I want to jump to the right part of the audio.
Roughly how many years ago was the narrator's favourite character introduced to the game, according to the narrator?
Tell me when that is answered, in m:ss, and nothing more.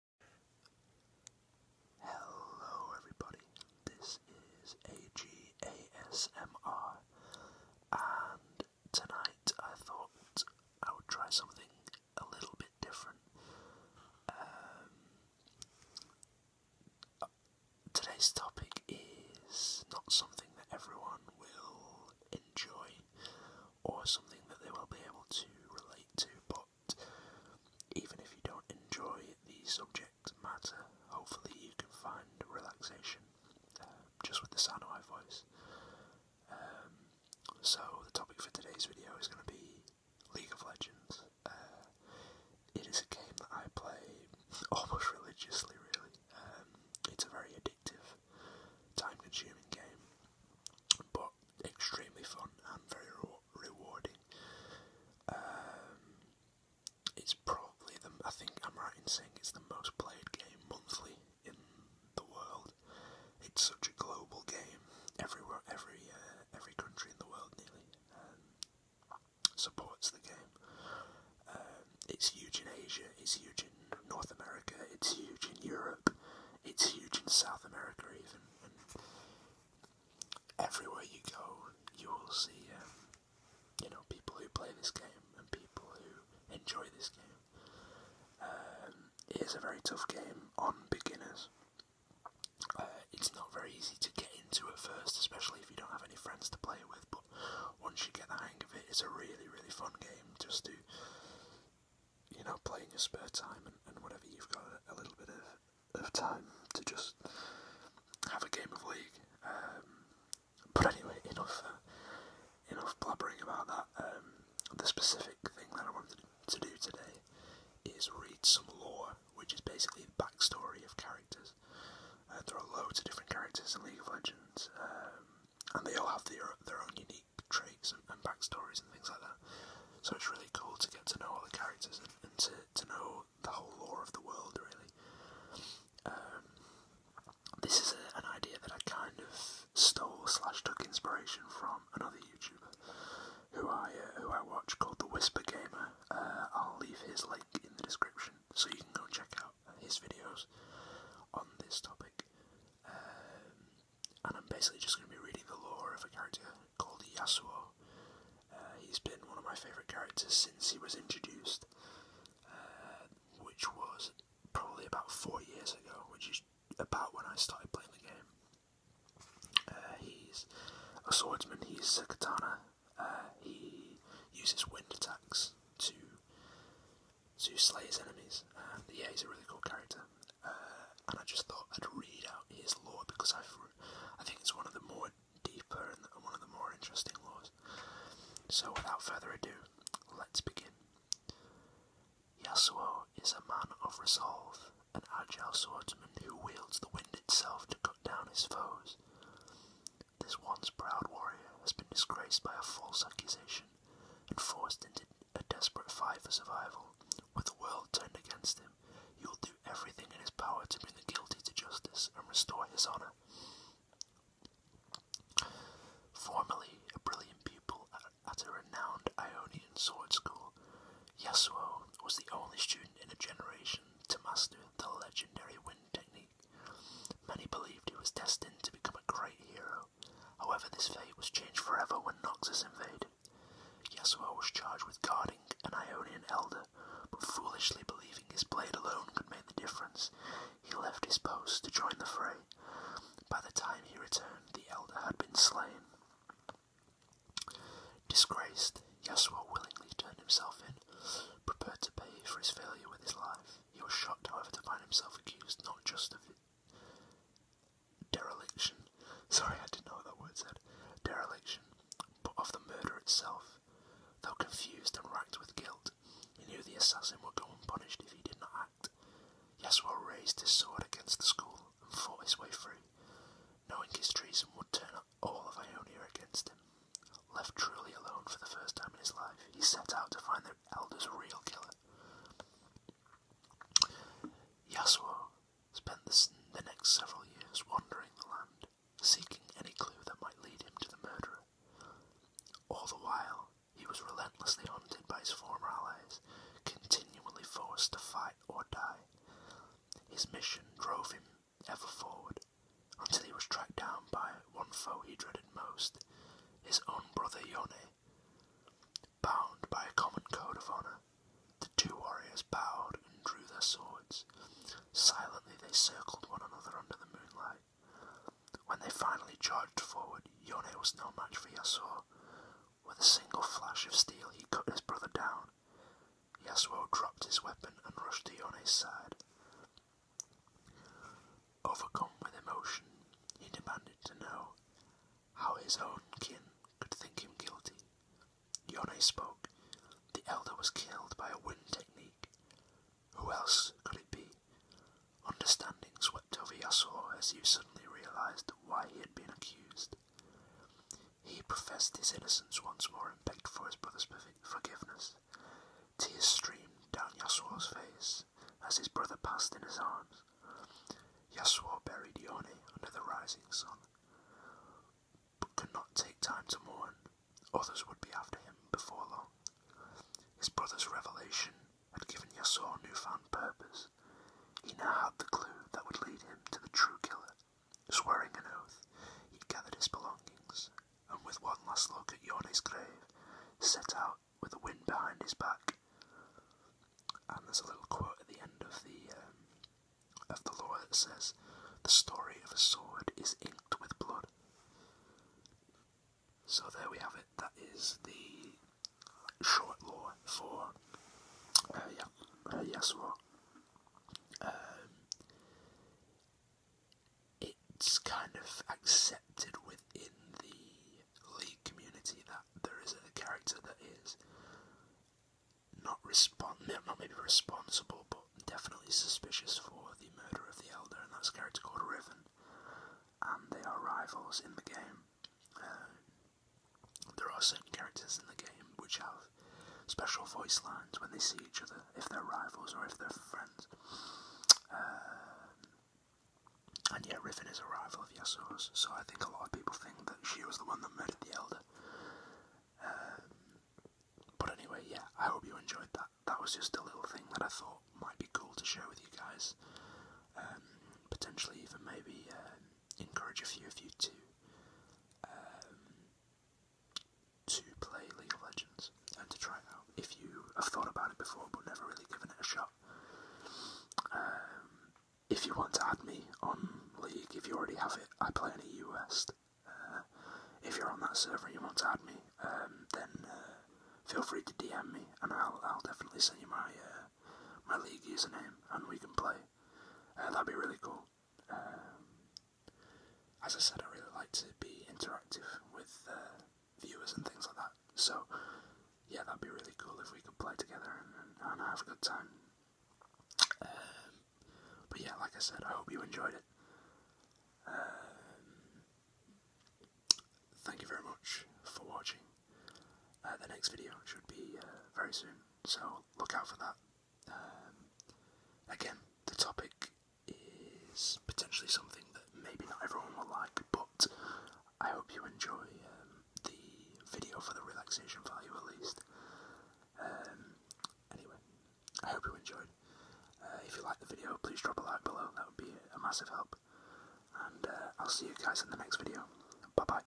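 2:45.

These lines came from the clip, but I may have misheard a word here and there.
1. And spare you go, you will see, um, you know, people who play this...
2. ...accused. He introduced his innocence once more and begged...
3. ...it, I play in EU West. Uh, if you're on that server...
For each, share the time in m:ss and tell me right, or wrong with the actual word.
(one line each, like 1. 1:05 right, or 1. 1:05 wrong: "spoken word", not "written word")
1. 1:18 wrong: "everywhere", not "spare"
2. 5:49 wrong: "professed", not "introduced"
3. 7:47 right.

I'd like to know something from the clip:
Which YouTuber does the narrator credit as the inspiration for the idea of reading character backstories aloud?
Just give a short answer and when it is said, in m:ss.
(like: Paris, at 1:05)
The Whisper Gamer, at 2:24.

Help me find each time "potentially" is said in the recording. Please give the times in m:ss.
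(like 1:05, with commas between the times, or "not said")
7:31, 8:31.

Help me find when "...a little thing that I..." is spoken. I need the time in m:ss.
7:26.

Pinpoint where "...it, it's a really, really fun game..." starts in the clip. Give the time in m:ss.
1:38.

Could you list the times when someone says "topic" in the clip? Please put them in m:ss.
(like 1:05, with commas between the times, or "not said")
0:18, 2:31, 8:29.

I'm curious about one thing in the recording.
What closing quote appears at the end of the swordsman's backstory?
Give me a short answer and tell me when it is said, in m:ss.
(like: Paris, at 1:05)
The story of a sword is inked with blood, at 6:31.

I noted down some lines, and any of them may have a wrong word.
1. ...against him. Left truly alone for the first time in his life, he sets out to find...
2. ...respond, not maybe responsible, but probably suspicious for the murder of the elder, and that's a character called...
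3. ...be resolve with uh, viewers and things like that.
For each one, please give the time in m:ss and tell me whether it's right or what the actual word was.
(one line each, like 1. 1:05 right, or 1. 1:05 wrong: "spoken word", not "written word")
1. 4:36 right
2. 6:56 wrong: "definitely", not "probably"
3. 8:04 wrong: "interactive", not "resolve".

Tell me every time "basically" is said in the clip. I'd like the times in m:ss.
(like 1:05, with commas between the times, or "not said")
1:59, 2:34.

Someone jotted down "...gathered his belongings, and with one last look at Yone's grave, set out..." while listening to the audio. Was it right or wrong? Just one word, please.
right.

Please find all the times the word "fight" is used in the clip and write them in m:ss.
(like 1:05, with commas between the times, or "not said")
3:25, 4:58.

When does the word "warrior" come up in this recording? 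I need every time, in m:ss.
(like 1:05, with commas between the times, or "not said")
3:21, 5:11.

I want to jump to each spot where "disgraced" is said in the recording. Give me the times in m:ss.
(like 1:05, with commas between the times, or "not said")
3:21, 4:08.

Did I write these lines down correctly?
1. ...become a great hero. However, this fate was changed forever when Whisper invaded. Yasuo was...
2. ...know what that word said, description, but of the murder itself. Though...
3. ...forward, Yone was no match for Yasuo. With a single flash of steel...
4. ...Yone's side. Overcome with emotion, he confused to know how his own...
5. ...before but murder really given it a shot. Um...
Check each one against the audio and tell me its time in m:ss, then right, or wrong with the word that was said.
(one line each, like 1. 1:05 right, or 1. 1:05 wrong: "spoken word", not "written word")
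1. 3:48 wrong: "Noxus", not "Whisper"
2. 4:19 wrong: "dereliction", not "description"
3. 5:19 right
4. 5:28 wrong: "demanded", not "confused"
5. 7:41 wrong: "never", not "murder".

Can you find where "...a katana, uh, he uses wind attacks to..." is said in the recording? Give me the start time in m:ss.
2:52.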